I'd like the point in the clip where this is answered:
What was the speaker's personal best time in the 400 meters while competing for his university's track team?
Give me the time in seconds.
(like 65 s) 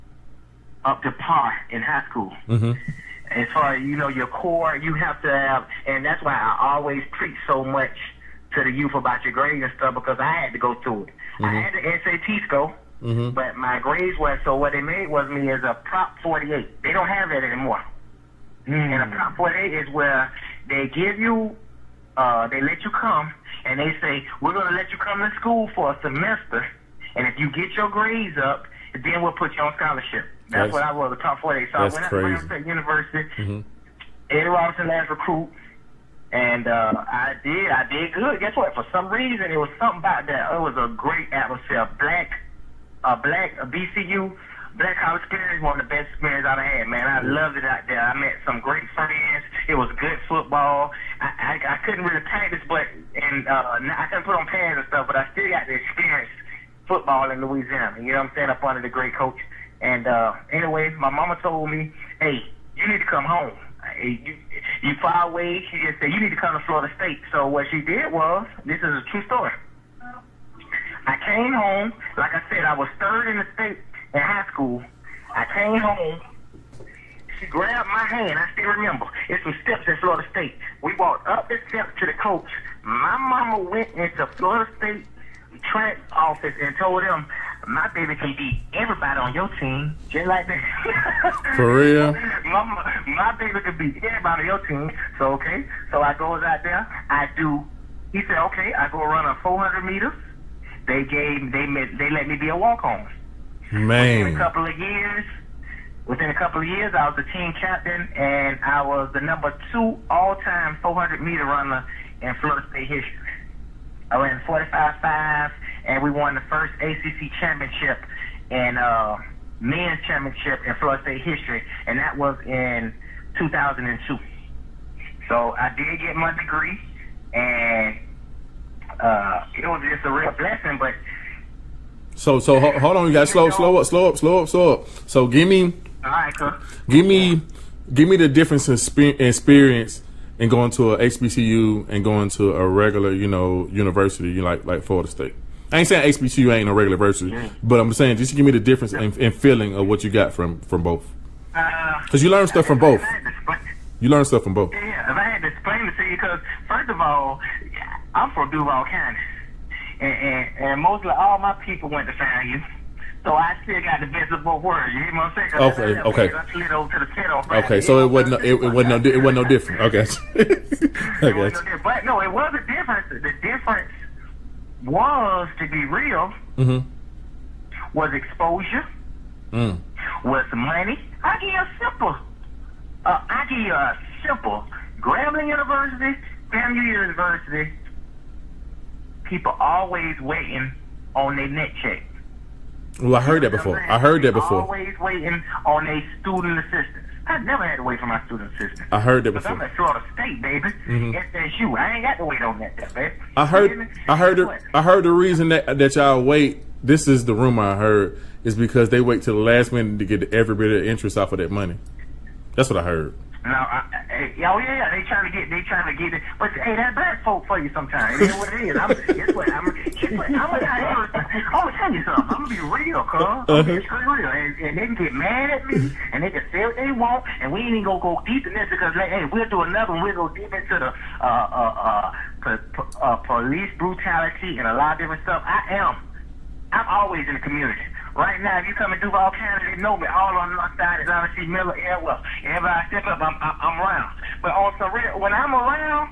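114 s.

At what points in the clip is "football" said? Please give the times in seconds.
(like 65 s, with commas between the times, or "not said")
50 s, 56 s.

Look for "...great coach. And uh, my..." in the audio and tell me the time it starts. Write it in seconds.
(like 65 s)
58 s.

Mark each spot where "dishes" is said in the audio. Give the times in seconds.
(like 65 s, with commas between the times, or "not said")
not said.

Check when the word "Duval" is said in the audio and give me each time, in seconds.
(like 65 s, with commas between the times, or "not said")
158 s, 238 s.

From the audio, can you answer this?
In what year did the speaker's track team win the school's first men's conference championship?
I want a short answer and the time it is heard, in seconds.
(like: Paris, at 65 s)
2002, at 123 s.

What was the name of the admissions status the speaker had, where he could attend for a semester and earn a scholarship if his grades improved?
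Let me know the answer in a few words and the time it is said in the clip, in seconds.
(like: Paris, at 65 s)
Prop 48, at 31 s.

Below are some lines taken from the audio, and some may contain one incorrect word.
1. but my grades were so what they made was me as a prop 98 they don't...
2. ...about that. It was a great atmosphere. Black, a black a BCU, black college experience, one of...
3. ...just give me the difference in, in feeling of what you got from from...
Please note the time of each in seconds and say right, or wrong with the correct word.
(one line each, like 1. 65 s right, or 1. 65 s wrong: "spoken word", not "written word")
1. 13 s wrong: "48", not "98"
2. 39 s right
3. 148 s right.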